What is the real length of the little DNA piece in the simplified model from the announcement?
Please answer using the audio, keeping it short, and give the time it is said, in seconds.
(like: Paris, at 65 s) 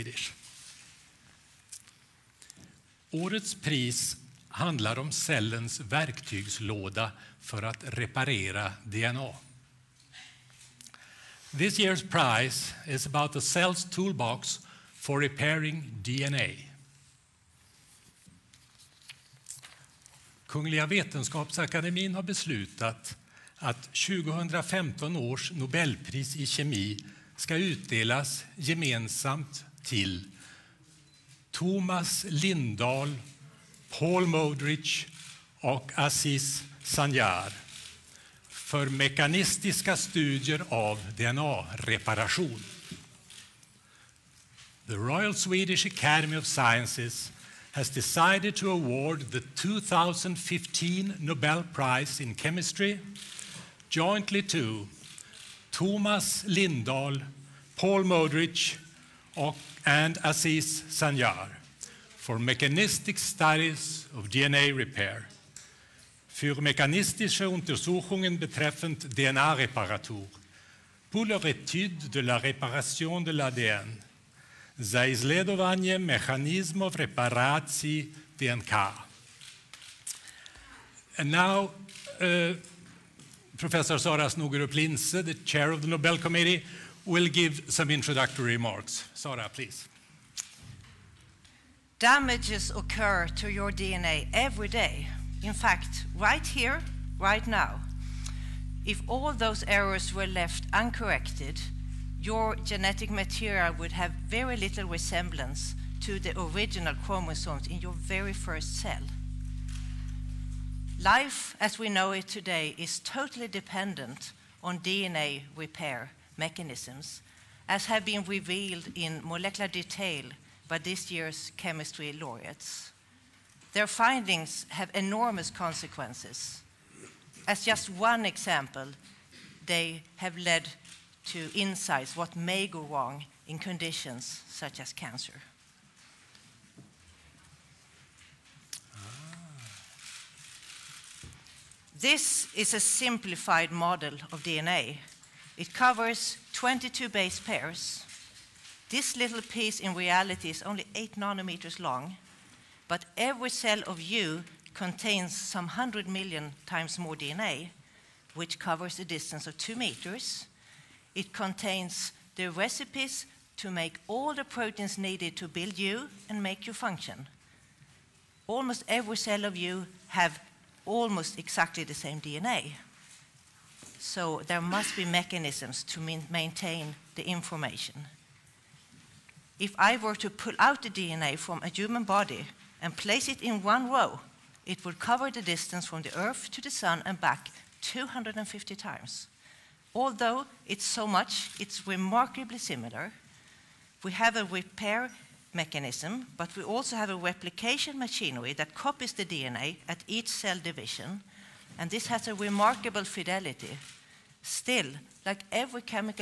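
8 nanometers, at 150 s.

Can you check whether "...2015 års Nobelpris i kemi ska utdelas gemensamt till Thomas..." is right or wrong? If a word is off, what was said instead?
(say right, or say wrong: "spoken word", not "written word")
right.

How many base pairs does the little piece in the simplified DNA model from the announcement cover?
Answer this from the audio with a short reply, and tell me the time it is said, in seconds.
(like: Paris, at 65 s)
22, at 146 s.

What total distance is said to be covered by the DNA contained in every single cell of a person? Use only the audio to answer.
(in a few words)
2 meters.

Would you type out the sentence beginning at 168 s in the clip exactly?
Almost every cell of you have almost exactly the same DNA.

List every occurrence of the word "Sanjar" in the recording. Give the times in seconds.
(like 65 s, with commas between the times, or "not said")
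36 s, 60 s.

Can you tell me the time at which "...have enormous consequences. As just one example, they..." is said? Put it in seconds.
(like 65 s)
124 s.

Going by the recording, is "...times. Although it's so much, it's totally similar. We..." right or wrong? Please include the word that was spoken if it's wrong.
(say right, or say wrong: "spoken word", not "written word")
wrong: "remarkably", not "totally".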